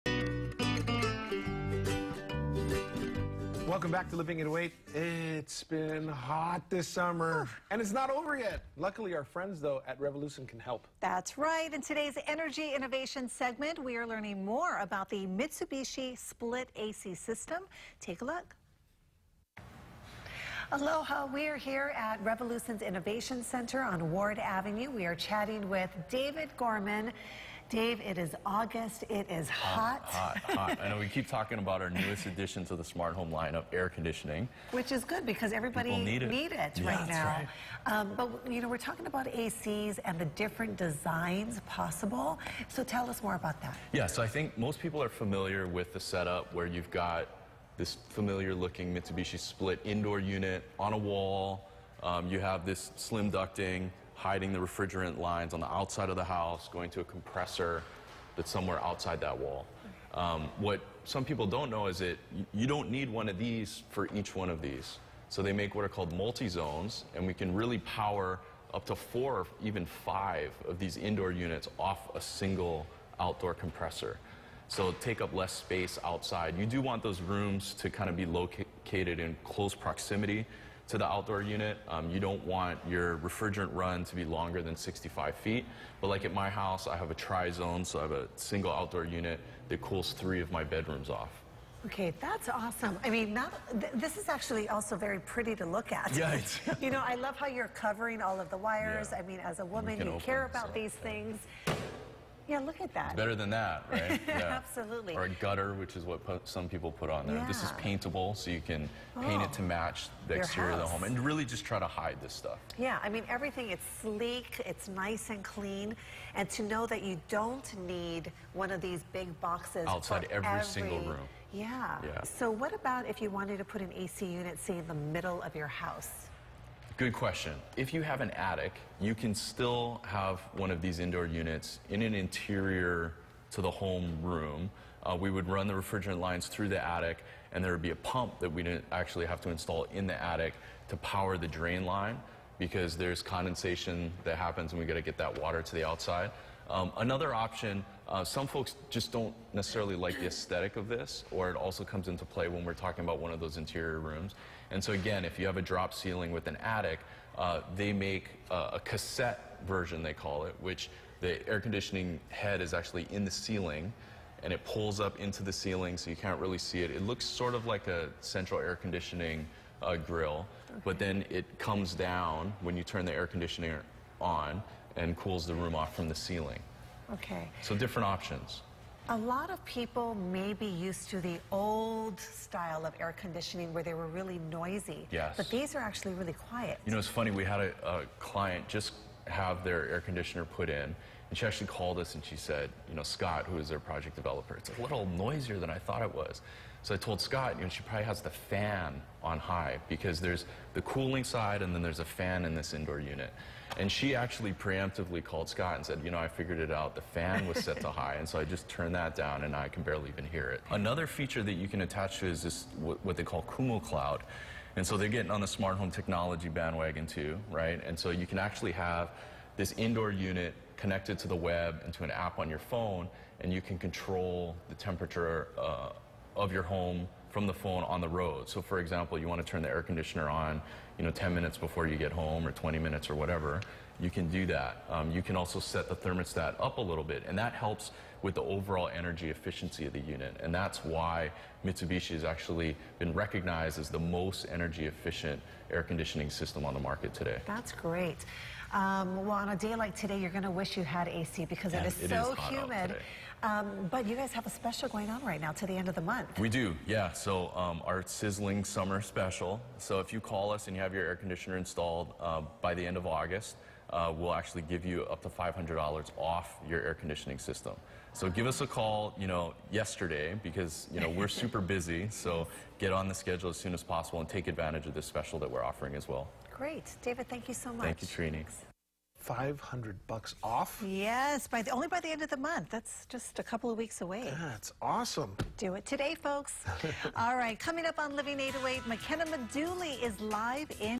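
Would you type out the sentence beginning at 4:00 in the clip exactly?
And that's why Mitsubishi has actually been recognized as the most energy efficient air conditioning system on the market today.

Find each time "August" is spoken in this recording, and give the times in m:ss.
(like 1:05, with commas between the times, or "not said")
0:28, 4:23.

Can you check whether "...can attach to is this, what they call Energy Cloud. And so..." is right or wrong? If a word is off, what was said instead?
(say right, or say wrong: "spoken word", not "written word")
wrong: "Kumo", not "Energy".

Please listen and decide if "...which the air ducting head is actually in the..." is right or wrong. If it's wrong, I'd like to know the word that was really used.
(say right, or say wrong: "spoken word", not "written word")
wrong: "conditioning", not "ducting".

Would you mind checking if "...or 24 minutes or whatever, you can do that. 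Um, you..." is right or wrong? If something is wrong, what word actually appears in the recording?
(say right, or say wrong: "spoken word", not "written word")
wrong: "20", not "24".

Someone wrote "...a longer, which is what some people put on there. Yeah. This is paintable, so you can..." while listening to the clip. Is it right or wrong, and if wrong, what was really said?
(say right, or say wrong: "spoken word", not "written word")
wrong: "gutter", not "longer".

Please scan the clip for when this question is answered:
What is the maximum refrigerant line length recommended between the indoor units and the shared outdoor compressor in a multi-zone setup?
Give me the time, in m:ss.
1:24.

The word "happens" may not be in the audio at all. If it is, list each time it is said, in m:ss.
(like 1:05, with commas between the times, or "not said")
2:24.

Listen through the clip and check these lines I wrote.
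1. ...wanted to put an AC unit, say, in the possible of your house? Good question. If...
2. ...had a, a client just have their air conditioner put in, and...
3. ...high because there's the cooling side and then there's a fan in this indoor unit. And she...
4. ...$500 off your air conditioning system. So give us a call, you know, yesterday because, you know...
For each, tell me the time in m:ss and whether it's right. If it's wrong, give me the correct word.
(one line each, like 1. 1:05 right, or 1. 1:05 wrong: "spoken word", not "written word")
1. 2:03 wrong: "middle", not "possible"
2. 3:07 right
3. 3:19 right
4. 4:25 right.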